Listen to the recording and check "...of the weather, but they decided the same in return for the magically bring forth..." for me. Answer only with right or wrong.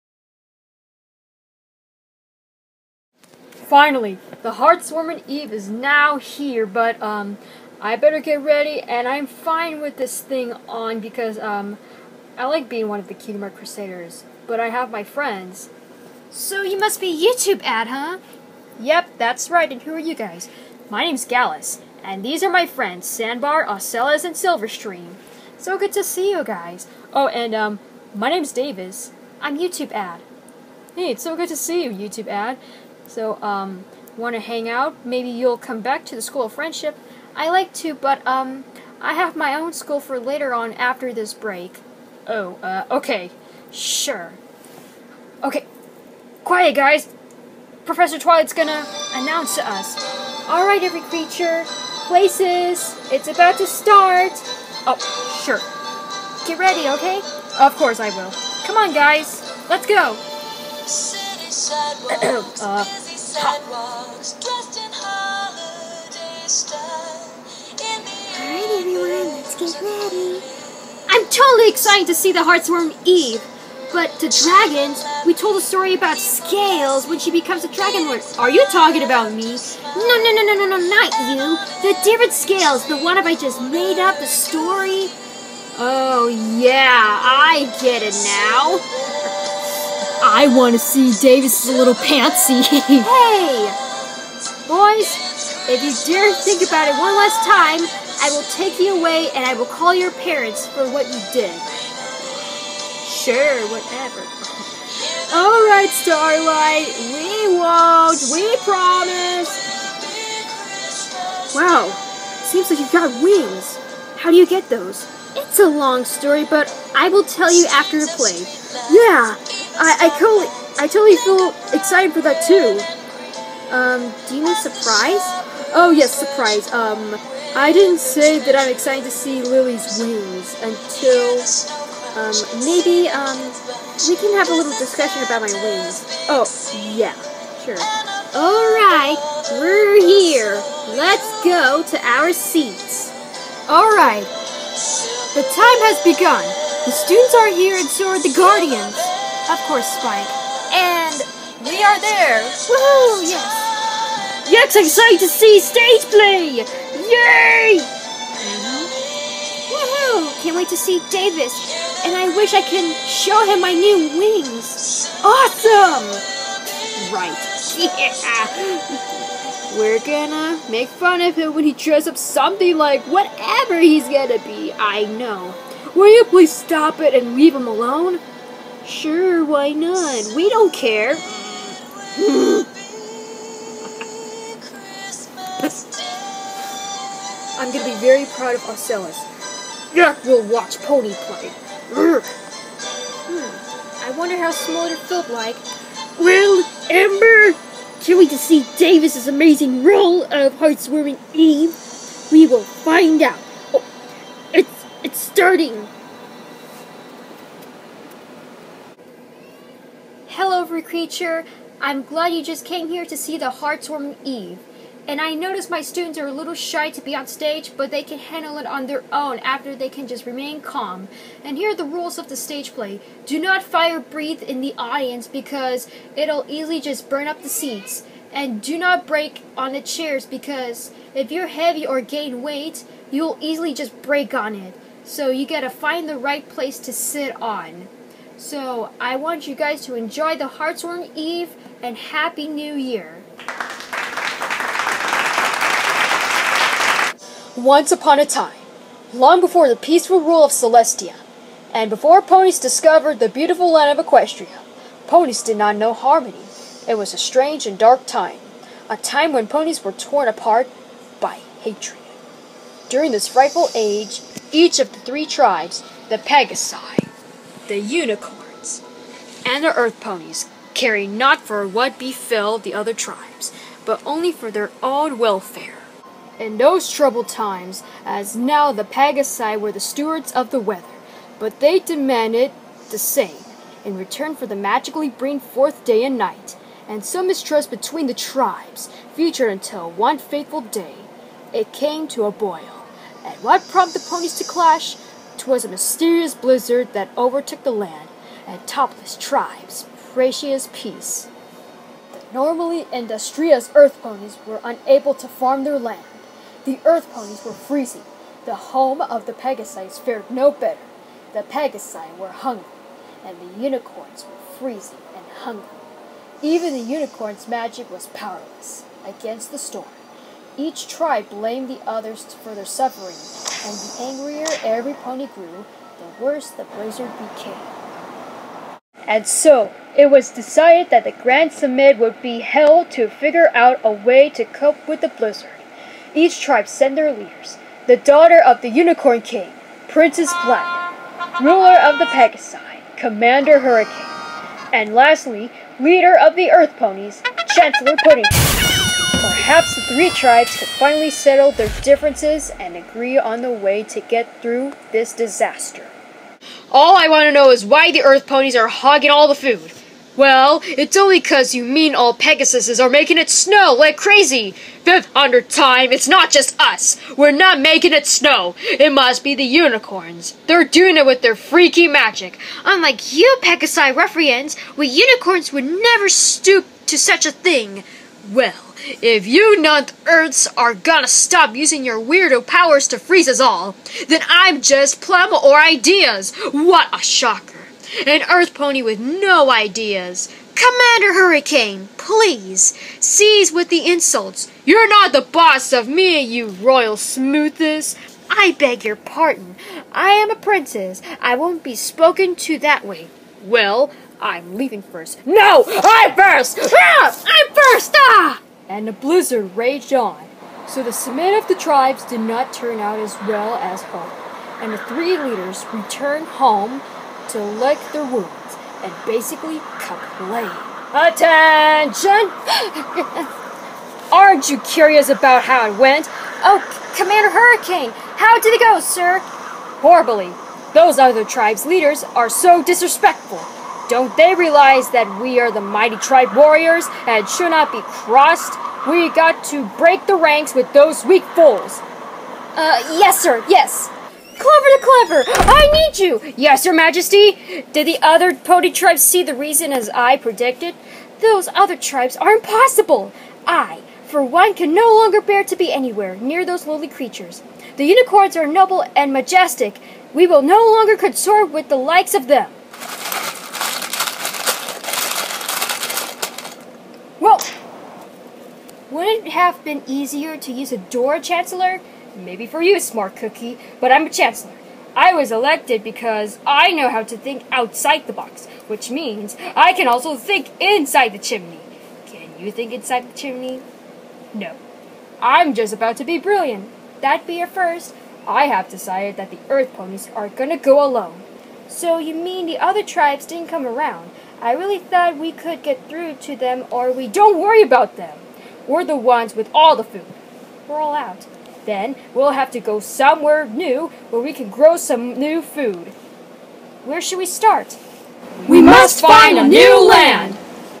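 wrong.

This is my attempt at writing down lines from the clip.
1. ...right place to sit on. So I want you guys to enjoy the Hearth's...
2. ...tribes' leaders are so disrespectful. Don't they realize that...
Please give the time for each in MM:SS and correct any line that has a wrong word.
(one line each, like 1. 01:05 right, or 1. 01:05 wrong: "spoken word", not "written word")
1. 03:56 right
2. 07:11 right.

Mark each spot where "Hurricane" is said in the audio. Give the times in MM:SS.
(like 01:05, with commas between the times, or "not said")
05:43, 06:31, 07:07.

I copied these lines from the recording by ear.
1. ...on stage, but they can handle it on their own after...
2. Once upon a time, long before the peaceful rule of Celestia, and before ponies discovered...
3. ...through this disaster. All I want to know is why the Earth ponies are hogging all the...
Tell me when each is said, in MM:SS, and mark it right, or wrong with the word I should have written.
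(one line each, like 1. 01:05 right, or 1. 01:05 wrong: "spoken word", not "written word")
1. 03:37 right
2. 04:07 right
3. 05:54 right.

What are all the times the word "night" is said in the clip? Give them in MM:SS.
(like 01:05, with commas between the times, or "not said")
04:46.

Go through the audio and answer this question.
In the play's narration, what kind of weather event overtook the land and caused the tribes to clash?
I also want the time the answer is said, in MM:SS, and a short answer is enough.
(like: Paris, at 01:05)
a mysterious blizzard, at 04:55.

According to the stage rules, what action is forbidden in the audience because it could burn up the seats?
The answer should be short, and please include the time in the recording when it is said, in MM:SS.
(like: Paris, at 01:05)
fire breathe, at 03:43.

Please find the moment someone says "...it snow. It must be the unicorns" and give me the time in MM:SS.
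06:07.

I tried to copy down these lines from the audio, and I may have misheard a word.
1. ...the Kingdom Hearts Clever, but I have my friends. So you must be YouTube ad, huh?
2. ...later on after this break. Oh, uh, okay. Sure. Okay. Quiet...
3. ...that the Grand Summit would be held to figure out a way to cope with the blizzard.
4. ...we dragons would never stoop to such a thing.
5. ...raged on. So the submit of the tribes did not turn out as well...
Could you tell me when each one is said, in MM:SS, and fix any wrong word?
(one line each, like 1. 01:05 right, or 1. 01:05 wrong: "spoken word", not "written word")
1. 00:13 wrong: "Crusaders", not "Clever"
2. 00:40 right
3. 05:30 right
4. 06:14 wrong: "unicorns", not "dragons"
5. 06:49 right.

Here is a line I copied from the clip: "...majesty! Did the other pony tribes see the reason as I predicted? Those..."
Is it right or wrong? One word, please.
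right.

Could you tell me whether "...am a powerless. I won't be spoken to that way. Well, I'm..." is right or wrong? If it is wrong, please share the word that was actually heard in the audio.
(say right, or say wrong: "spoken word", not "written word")
wrong: "princess", not "powerless".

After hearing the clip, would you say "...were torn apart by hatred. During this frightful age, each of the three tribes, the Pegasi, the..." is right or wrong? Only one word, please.
right.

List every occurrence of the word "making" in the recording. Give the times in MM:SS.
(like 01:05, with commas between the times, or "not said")
06:02, 06:07.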